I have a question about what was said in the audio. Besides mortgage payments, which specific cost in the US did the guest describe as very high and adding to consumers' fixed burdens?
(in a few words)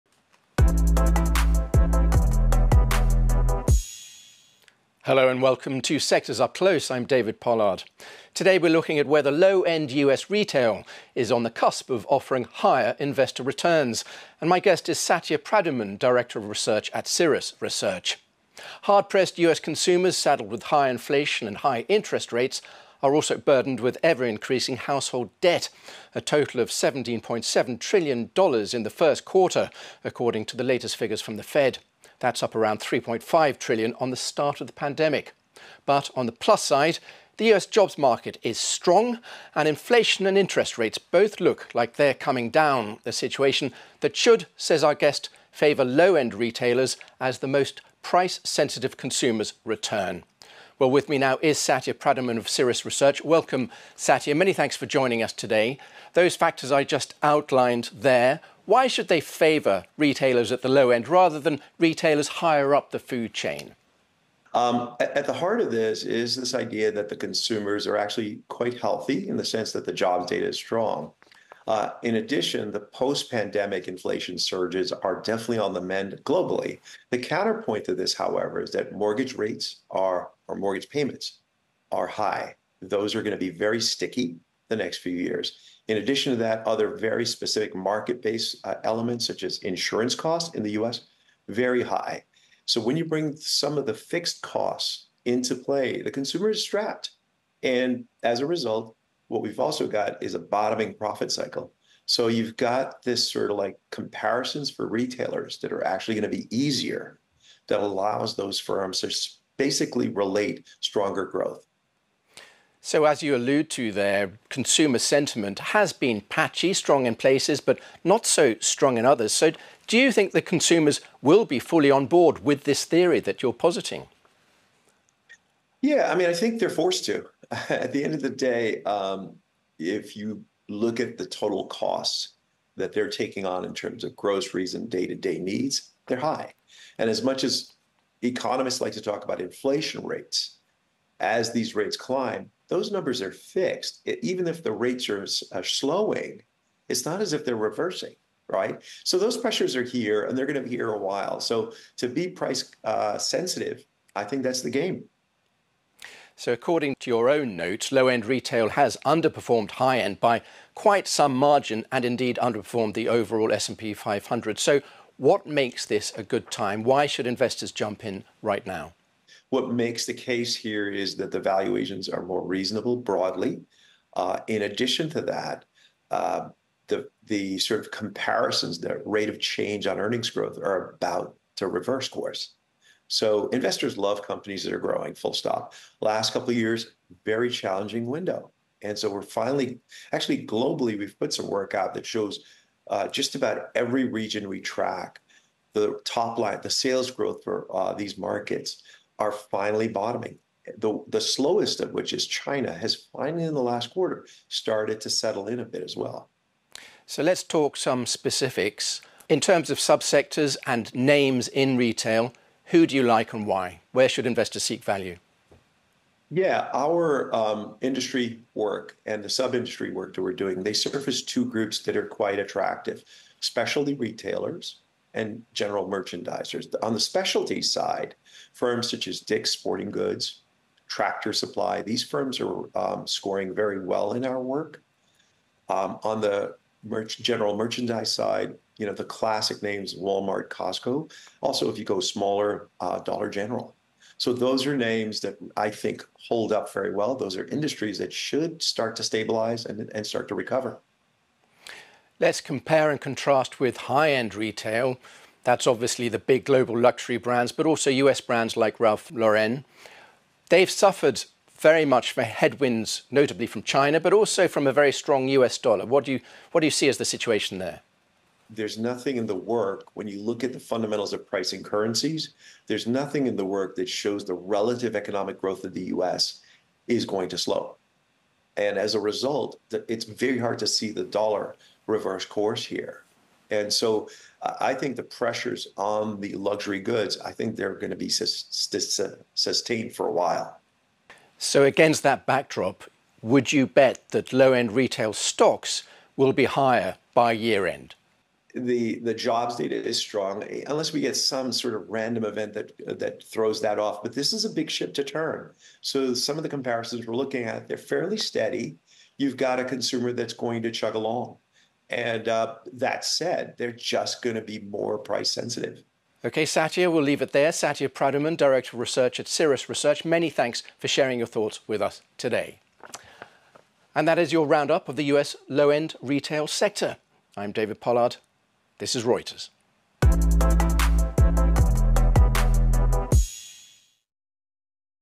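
insurance costs.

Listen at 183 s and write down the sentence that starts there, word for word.
So investors love companies that are growing, full stop.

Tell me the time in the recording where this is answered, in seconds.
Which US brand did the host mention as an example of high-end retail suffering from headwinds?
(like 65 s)
258 s.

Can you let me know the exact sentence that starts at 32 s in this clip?
That's up around 3.5 trillion on the start of the pandemic.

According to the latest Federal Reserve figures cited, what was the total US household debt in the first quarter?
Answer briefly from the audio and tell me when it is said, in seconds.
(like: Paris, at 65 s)
$17.7 trillion, at 26 s.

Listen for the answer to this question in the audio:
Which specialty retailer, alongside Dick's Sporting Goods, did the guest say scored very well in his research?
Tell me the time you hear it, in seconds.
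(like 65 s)
230 s.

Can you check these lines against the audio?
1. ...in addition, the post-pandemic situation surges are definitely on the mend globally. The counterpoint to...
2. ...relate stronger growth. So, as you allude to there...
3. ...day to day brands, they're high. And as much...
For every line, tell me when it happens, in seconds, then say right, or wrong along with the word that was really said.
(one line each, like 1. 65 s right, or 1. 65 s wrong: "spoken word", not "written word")
1. 72 s wrong: "inflation", not "situation"
2. 110 s right
3. 134 s wrong: "needs", not "brands".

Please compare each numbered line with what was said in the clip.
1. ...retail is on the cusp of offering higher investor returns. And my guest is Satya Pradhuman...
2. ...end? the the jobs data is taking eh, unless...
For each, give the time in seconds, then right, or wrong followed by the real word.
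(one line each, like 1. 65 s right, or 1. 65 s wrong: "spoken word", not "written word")
1. 10 s right
2. 297 s wrong: "strong", not "taking".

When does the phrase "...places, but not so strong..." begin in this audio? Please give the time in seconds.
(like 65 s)
117 s.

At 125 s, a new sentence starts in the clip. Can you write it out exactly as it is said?
Yeah, I mean, I think they're forced to.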